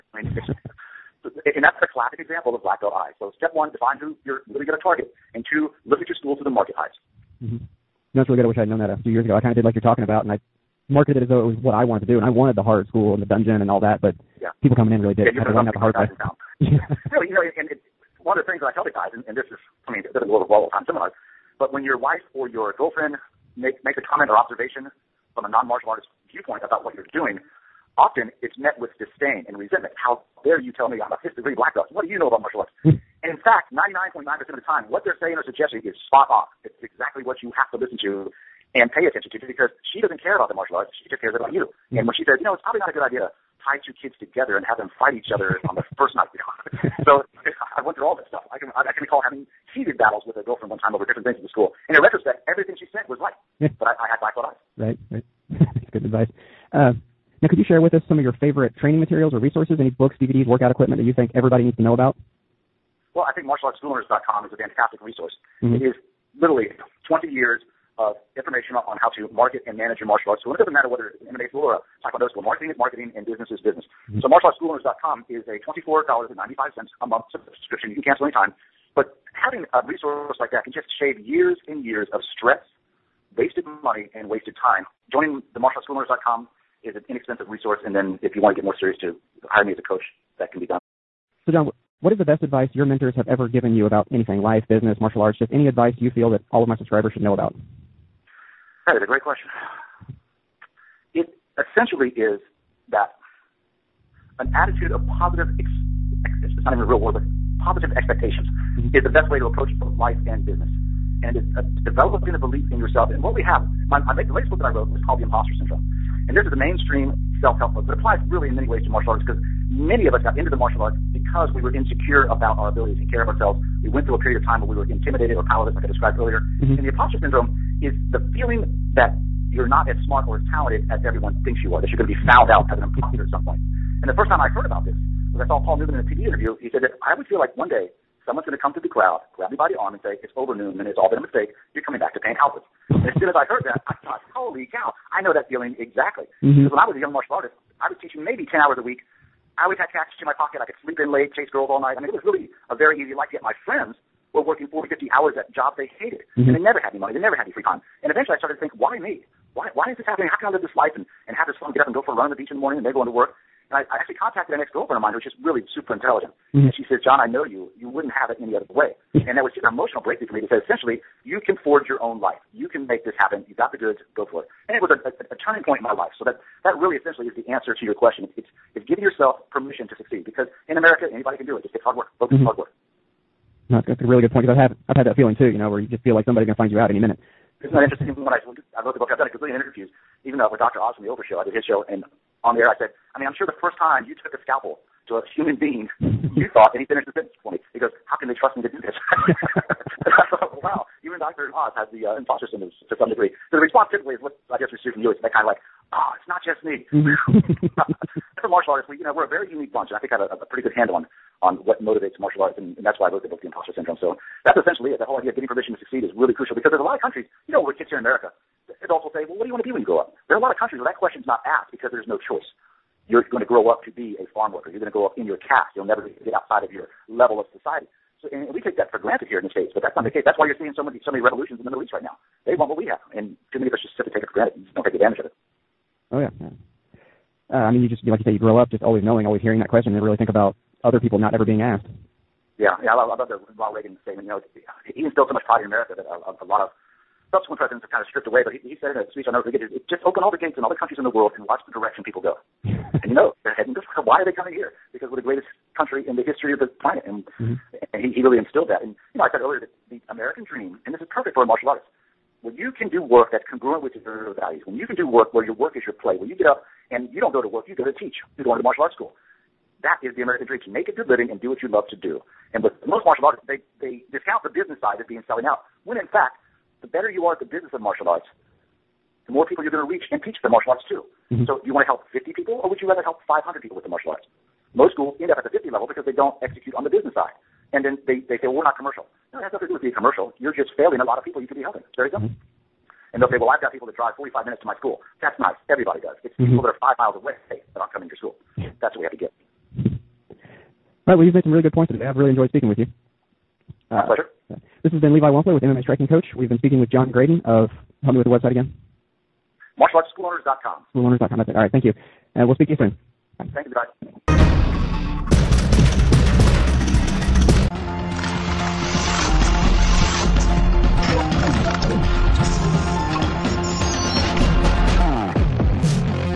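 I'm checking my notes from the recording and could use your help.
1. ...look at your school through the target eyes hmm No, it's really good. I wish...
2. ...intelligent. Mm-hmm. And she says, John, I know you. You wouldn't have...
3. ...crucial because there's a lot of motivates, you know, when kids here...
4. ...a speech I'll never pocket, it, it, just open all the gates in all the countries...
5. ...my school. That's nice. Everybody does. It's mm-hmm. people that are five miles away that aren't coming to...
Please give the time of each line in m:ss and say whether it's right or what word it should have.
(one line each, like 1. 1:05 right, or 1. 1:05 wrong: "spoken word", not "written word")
1. 0:05 wrong: "market", not "target"
2. 2:45 right
3. 3:36 wrong: "countries", not "motivates"
4. 4:08 wrong: "forget", not "pocket"
5. 4:54 right.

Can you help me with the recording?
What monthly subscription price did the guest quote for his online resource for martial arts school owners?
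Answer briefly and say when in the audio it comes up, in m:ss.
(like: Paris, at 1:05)
$24.95, at 1:15.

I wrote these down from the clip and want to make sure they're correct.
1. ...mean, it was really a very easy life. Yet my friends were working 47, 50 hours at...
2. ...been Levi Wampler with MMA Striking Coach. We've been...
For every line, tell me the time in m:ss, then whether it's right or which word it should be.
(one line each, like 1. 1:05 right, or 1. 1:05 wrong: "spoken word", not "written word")
1. 2:31 wrong: "40", not "47"
2. 5:05 right.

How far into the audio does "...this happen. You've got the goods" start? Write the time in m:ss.
2:53.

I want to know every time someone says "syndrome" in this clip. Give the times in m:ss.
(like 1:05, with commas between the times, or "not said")
1:55, 2:07, 3:22, 3:33.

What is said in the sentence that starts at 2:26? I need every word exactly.
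Because when I was a young martial artist, I was teaching maybe ten hours a week.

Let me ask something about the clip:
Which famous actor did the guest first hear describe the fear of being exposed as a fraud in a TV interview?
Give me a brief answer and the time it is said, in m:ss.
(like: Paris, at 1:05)
Paul Newman, at 2:15.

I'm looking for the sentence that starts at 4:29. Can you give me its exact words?
That is the American dream to make a good living and do what you love to do.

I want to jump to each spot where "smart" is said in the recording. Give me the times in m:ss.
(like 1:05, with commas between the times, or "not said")
2:10.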